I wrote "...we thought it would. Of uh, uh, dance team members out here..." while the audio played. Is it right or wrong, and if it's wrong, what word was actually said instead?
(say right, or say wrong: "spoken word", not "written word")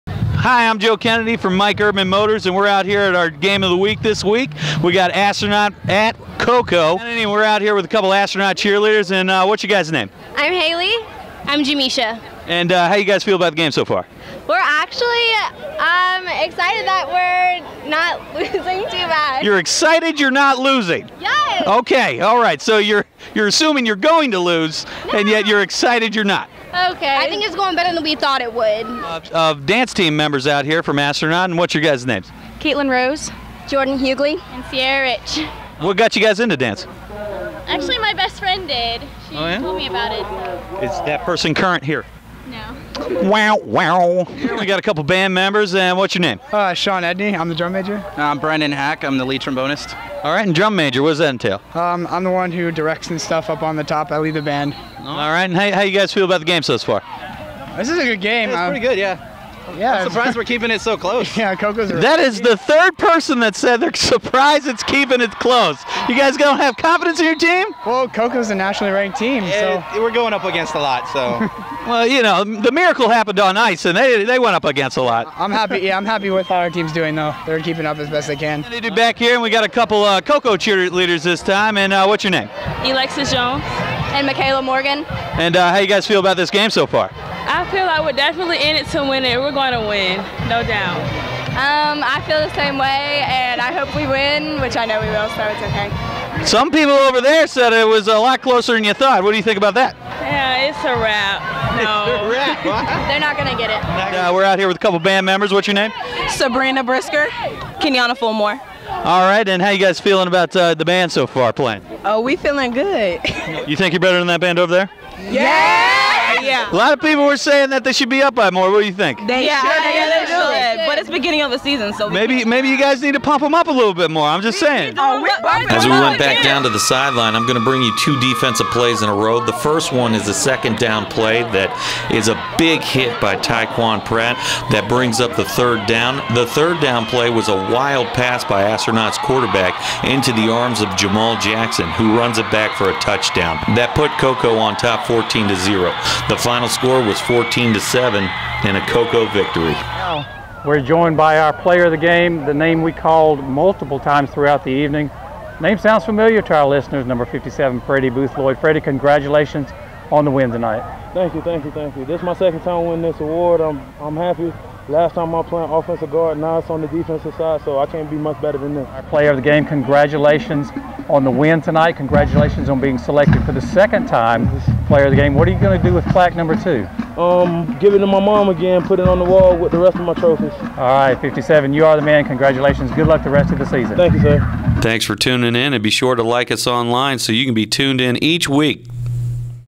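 right.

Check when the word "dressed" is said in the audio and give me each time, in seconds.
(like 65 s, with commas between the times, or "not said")
not said.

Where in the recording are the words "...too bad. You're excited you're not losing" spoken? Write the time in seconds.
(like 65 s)
18 s.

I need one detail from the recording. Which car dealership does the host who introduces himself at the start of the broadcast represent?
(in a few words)
Mike Erdman Motors.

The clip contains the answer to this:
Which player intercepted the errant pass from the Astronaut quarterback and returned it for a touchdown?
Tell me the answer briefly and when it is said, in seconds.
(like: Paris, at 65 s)
Jamal Jackson, at 140 s.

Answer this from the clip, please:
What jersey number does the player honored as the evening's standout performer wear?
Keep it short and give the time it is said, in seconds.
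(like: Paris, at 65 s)
57, at 157 s.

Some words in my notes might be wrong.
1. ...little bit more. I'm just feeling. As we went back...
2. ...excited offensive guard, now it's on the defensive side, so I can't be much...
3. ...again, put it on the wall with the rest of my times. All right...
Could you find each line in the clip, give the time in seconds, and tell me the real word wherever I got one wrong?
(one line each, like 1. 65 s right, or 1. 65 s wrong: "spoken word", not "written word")
1. 123 s wrong: "saying", not "feeling"
2. 165 s wrong: "played", not "excited"
3. 178 s wrong: "trophies", not "times".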